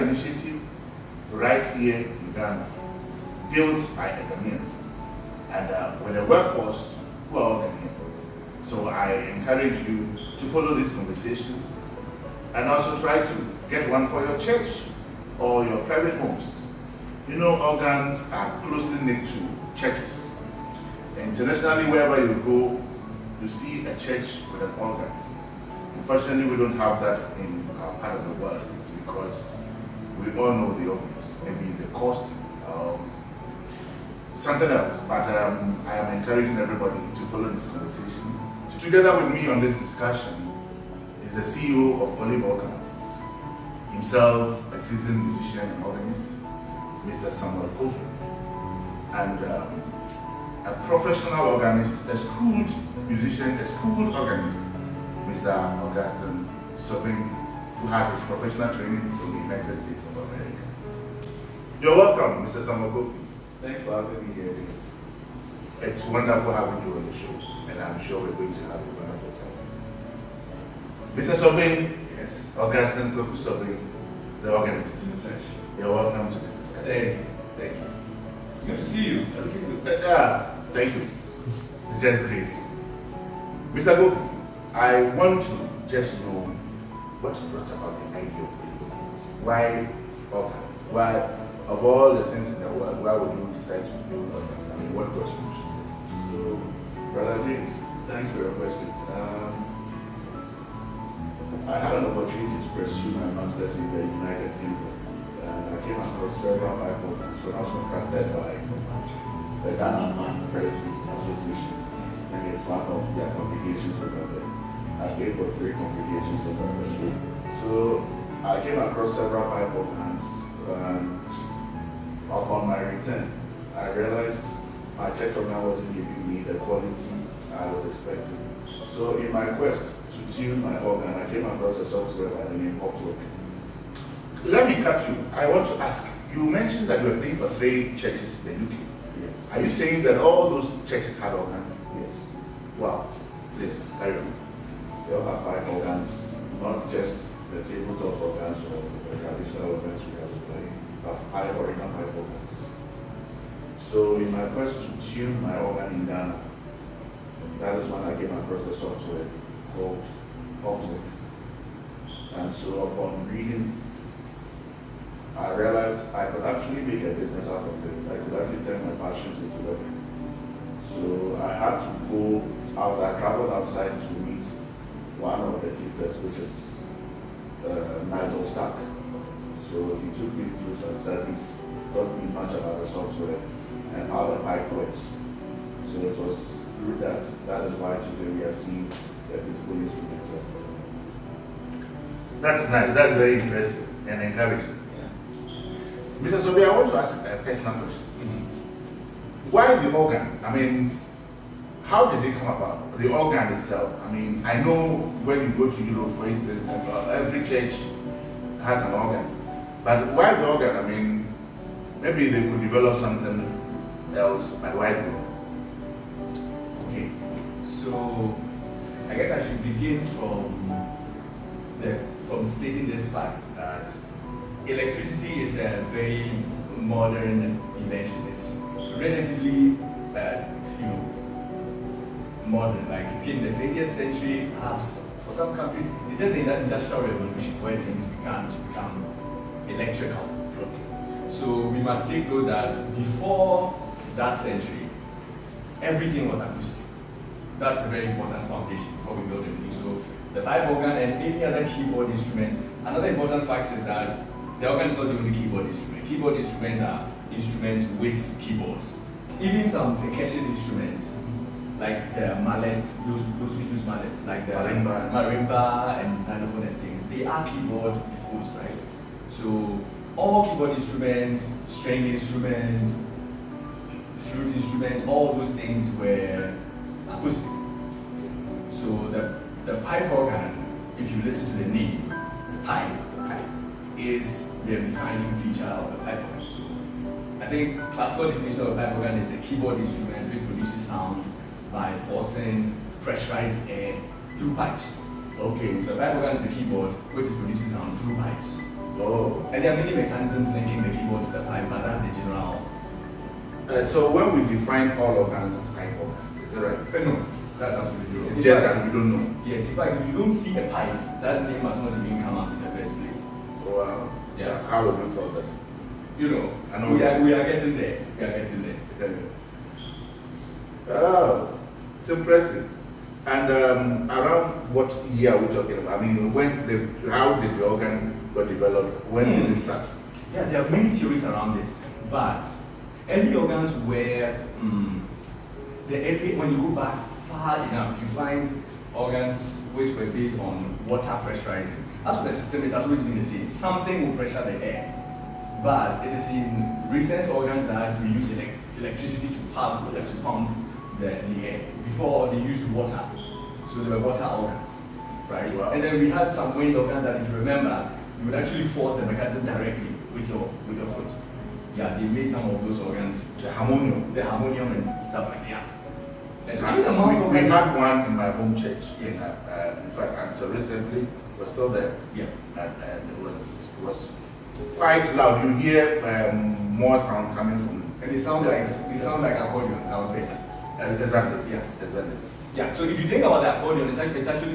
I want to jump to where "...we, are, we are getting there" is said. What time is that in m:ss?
5:16.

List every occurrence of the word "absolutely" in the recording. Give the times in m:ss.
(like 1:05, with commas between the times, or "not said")
5:07.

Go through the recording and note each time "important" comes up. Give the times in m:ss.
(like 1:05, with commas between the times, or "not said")
4:08, 4:13.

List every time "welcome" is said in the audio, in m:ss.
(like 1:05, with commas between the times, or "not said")
1:01, 1:15.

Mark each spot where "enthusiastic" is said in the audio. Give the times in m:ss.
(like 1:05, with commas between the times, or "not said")
not said.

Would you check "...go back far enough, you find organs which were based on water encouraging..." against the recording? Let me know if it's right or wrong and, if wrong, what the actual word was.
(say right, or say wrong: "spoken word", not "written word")
wrong: "pressurizing", not "encouraging".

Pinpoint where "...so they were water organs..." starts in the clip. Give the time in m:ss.
5:53.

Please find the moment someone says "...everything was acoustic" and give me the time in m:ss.
4:05.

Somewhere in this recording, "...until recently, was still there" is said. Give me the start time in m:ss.
6:10.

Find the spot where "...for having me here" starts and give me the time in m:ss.
1:03.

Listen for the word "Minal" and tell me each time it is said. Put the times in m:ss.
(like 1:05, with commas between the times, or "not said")
not said.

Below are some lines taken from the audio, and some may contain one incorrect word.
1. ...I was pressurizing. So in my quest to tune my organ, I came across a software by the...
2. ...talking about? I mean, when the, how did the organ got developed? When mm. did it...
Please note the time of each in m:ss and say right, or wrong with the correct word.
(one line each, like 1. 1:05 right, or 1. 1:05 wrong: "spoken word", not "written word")
1. 2:07 wrong: "expecting", not "pressurizing"
2. 5:25 right.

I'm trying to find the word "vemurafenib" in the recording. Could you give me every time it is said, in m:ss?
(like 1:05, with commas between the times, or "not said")
not said.